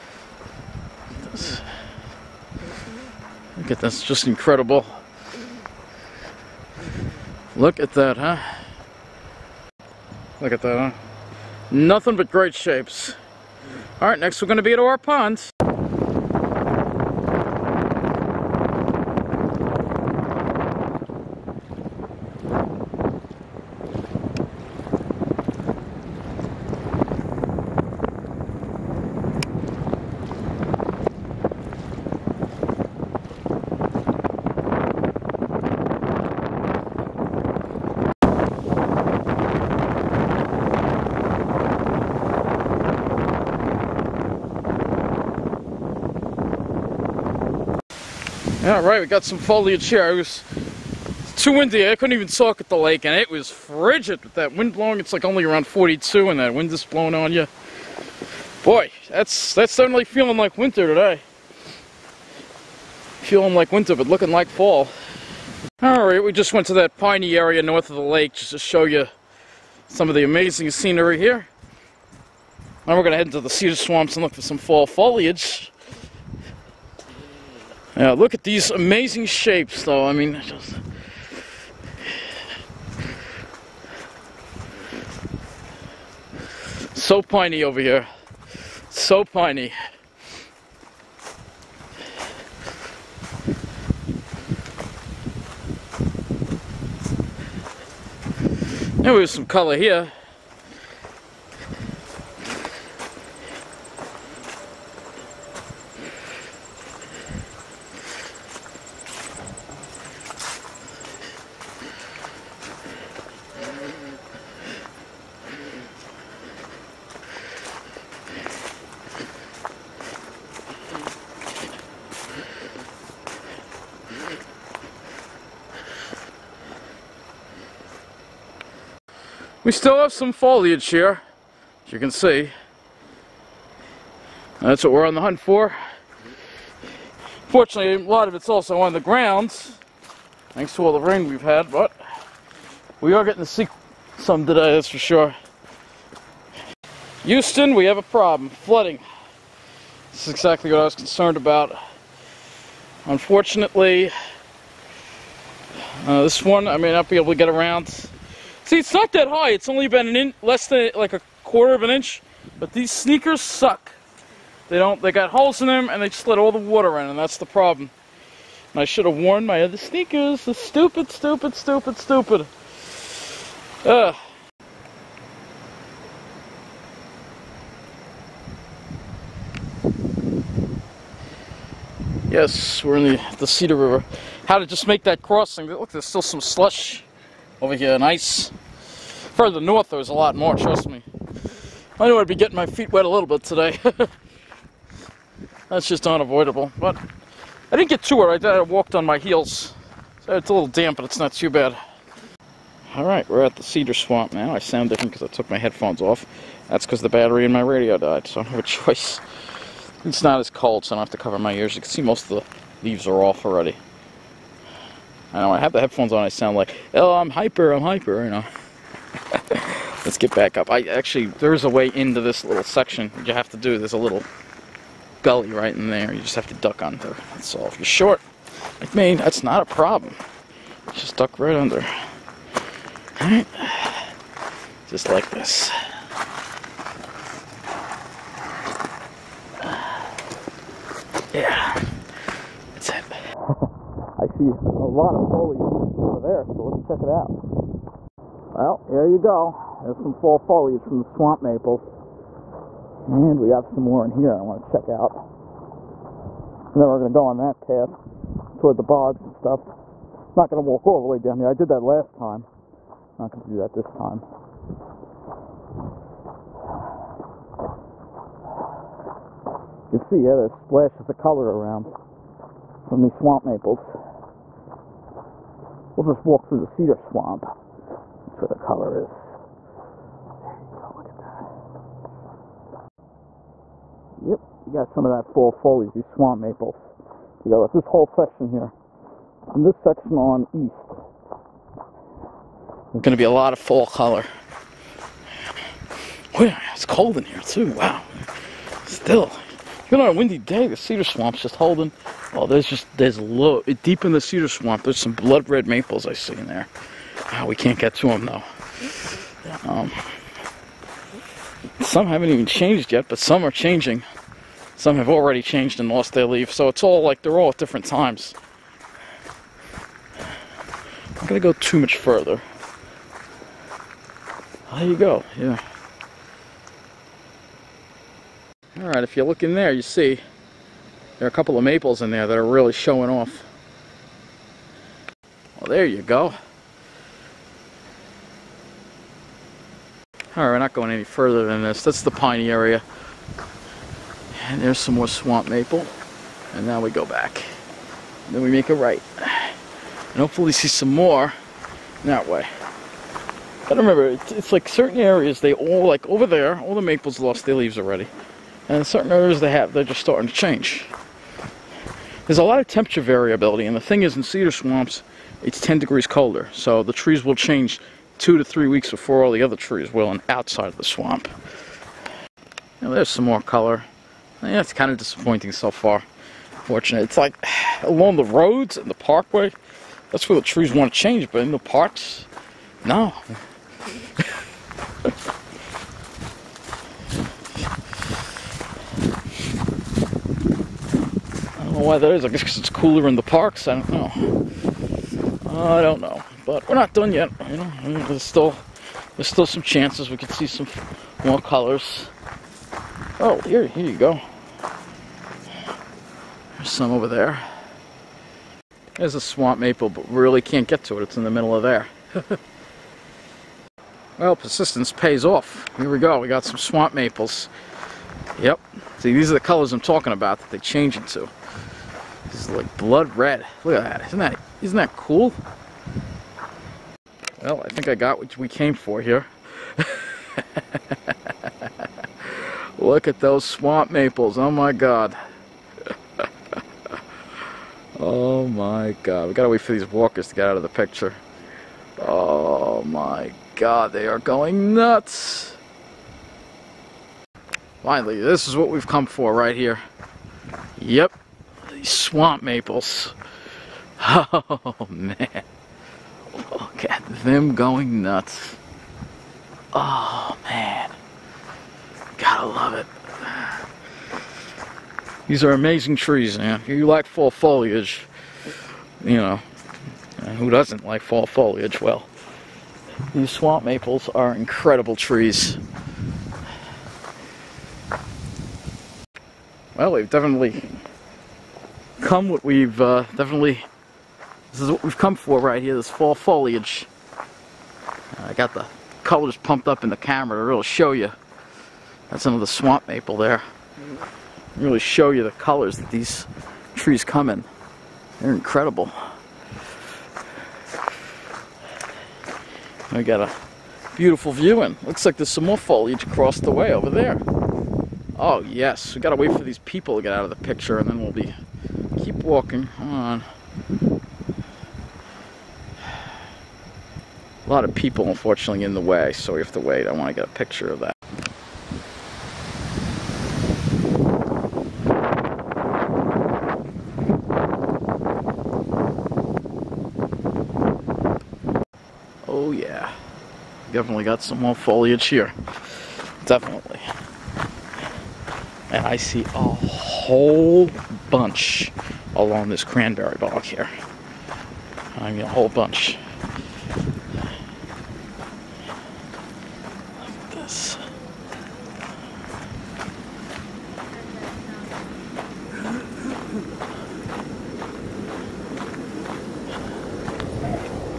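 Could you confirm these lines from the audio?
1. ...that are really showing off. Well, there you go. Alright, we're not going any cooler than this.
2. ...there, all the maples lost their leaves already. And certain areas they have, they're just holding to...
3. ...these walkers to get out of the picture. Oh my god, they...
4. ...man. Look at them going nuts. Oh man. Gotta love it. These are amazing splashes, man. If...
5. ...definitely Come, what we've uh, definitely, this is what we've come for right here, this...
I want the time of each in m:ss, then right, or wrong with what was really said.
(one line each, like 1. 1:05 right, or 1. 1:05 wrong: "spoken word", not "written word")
1. 5:32 wrong: "further", not "cooler"
2. 5:56 wrong: "starting", not "holding"
3. 7:19 right
4. 7:34 wrong: "trees", not "splashes"
5. 8:00 right.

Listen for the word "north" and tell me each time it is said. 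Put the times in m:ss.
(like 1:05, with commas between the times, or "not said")
1:07, 3:09.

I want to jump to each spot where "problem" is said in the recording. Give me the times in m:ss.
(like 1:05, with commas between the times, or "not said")
2:28, 2:47, 3:49.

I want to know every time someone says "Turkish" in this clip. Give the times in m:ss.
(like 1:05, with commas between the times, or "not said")
not said.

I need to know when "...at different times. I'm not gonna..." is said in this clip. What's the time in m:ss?
5:17.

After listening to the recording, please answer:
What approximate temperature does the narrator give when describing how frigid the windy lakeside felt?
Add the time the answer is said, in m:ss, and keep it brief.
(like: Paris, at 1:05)
42, at 0:55.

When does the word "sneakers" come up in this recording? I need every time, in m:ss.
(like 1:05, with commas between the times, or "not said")
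2:42, 2:49.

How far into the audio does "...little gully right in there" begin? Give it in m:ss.
3:43.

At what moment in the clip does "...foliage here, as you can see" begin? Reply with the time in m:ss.
2:10.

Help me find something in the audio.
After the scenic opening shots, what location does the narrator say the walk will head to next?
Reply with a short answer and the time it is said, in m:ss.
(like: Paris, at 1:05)
Ore Ponds, at 0:14.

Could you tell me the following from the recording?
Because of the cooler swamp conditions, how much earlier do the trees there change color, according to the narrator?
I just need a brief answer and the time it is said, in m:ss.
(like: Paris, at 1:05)
2 to 3 weeks, at 6:08.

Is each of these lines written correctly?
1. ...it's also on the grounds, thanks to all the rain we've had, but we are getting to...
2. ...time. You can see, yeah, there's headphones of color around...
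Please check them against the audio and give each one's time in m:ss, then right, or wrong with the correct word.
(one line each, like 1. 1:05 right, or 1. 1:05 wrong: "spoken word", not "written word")
1. 2:18 right
2. 4:23 wrong: "splashes", not "headphones".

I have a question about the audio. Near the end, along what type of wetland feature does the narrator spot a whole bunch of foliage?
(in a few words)
cranberry bog.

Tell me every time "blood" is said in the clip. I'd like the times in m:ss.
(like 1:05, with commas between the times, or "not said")
5:05, 7:02.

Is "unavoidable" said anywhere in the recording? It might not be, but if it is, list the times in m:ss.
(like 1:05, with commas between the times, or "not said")
3:16.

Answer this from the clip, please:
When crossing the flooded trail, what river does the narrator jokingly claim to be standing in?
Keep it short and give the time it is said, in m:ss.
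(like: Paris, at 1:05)
Cedar River, at 3:03.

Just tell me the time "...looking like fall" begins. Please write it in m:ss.
1:04.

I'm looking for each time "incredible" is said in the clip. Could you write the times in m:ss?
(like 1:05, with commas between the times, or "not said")
0:04, 7:54, 8:18.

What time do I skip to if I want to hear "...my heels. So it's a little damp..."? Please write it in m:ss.
3:19.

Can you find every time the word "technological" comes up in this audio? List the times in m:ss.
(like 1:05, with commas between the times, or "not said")
not said.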